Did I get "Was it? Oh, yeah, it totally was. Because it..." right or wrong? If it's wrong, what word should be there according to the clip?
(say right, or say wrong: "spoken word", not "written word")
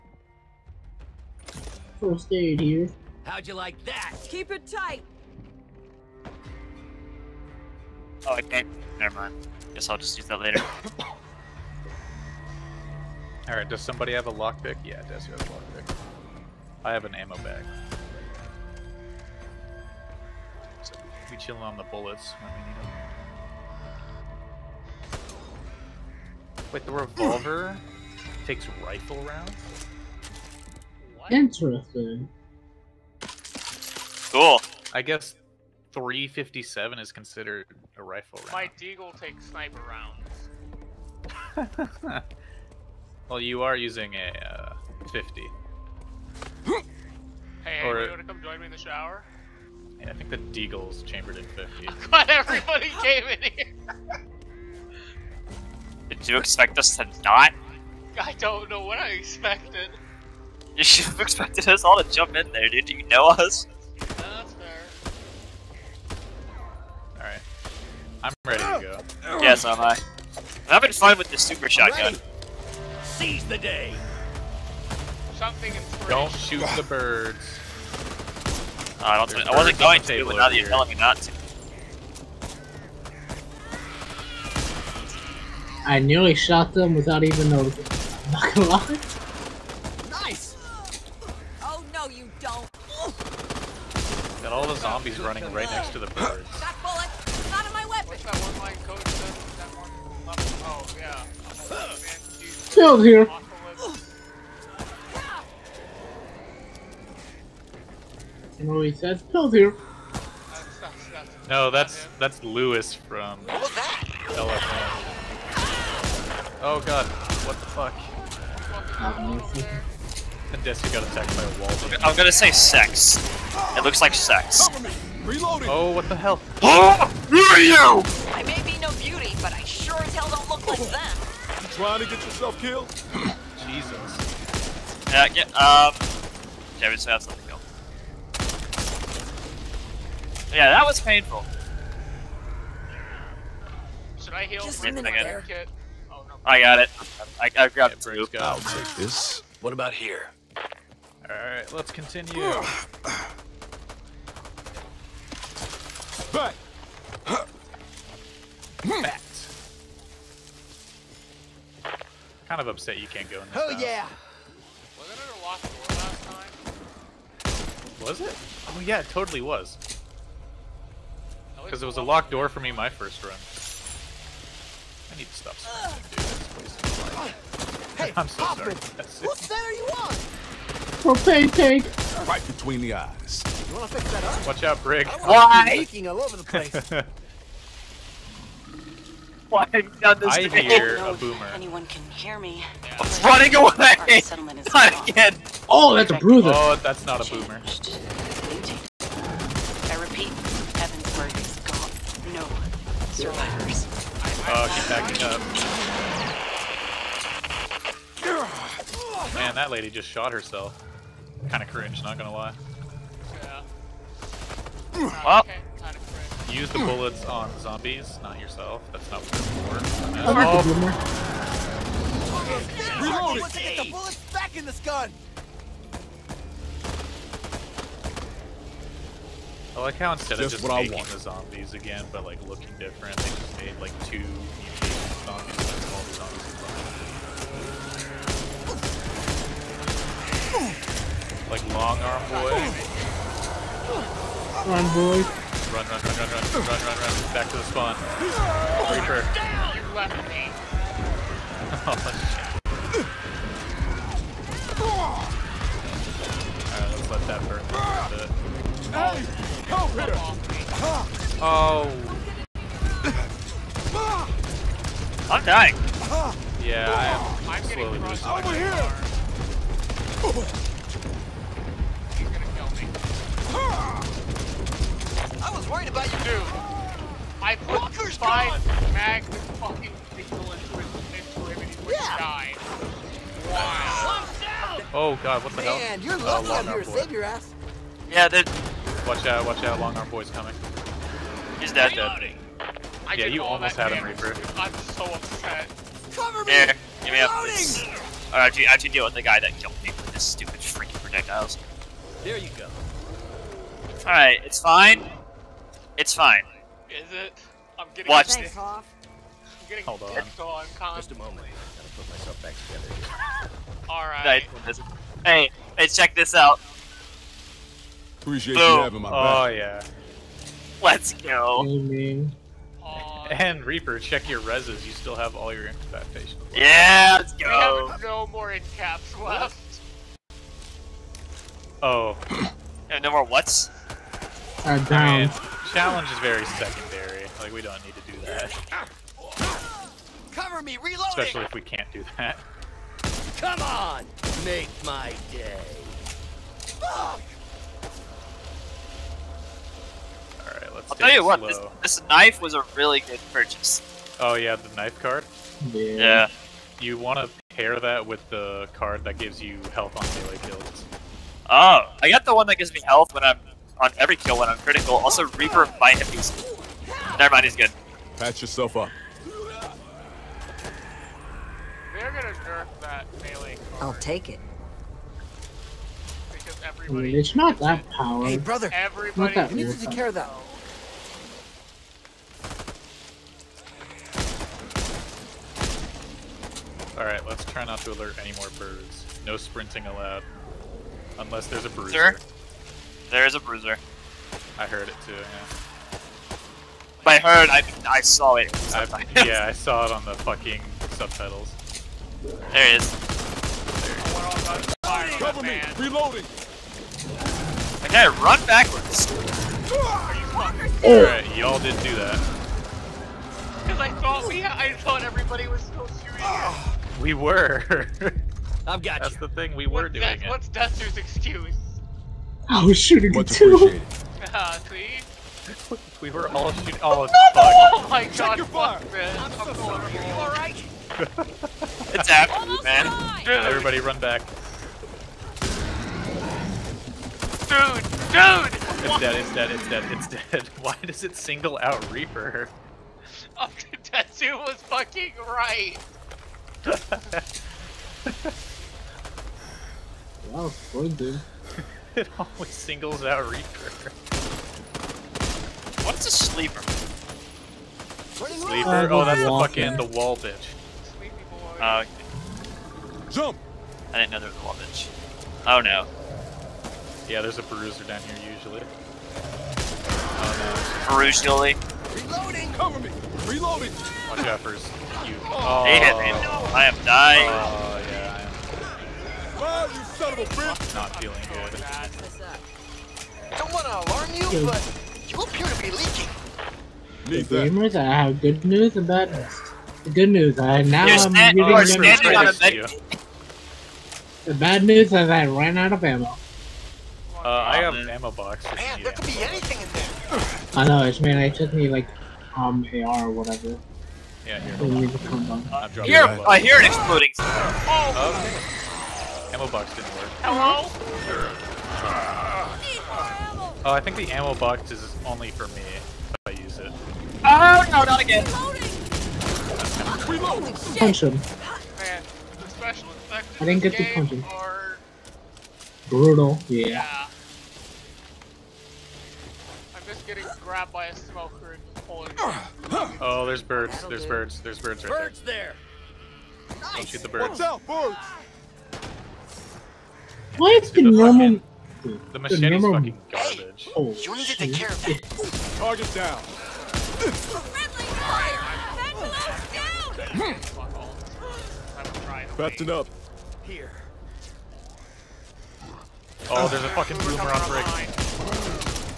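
right.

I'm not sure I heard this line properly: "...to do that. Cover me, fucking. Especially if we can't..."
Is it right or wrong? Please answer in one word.
wrong.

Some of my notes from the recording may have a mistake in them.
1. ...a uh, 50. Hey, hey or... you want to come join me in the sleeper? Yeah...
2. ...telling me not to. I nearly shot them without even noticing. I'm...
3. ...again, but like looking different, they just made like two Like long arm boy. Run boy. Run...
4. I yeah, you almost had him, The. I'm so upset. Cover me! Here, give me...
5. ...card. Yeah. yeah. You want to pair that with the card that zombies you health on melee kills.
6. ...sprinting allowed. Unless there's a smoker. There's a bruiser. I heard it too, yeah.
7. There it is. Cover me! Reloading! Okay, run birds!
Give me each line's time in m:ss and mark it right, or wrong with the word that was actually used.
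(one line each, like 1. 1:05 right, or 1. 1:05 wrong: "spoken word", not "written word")
1. 0:44 wrong: "shower", not "sleeper"
2. 1:20 right
3. 3:51 right
4. 4:53 wrong: "Reaper", not "The"
5. 5:54 wrong: "gives", not "zombies"
6. 6:29 wrong: "bruiser", not "smoker"
7. 6:42 wrong: "backwards", not "birds".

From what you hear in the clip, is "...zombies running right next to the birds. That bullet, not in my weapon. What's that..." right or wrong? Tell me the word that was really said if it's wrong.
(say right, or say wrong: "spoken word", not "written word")
right.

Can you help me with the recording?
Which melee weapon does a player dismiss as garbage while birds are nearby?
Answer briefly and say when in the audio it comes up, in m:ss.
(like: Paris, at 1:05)
machete, at 9:02.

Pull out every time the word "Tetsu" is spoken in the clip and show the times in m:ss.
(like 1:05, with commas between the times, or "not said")
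7:23.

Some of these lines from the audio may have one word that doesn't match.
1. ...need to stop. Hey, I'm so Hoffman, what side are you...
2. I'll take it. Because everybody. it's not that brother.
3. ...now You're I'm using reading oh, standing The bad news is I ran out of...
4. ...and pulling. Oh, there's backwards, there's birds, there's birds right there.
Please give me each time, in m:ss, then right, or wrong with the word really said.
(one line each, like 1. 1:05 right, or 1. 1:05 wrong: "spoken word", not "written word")
1. 2:55 right
2. 6:13 wrong: "power", not "brother"
3. 8:10 right
4. 8:51 wrong: "birds", not "backwards".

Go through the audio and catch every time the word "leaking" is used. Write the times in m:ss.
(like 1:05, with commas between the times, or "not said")
3:05, 8:05.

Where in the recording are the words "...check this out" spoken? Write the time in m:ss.
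5:15.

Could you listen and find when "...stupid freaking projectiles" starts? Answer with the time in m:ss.
5:00.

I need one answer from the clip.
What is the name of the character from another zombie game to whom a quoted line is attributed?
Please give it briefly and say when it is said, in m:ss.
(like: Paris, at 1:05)
Louis, at 1:52.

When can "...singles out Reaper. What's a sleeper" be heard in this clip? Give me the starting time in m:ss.
7:32.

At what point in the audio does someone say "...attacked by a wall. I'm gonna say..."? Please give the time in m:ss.
2:01.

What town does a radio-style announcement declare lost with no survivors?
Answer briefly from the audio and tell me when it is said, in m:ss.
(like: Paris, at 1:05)
Evansburg, at 3:20.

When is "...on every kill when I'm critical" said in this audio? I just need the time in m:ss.
6:03.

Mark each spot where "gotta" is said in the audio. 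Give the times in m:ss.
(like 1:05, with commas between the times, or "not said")
5:11.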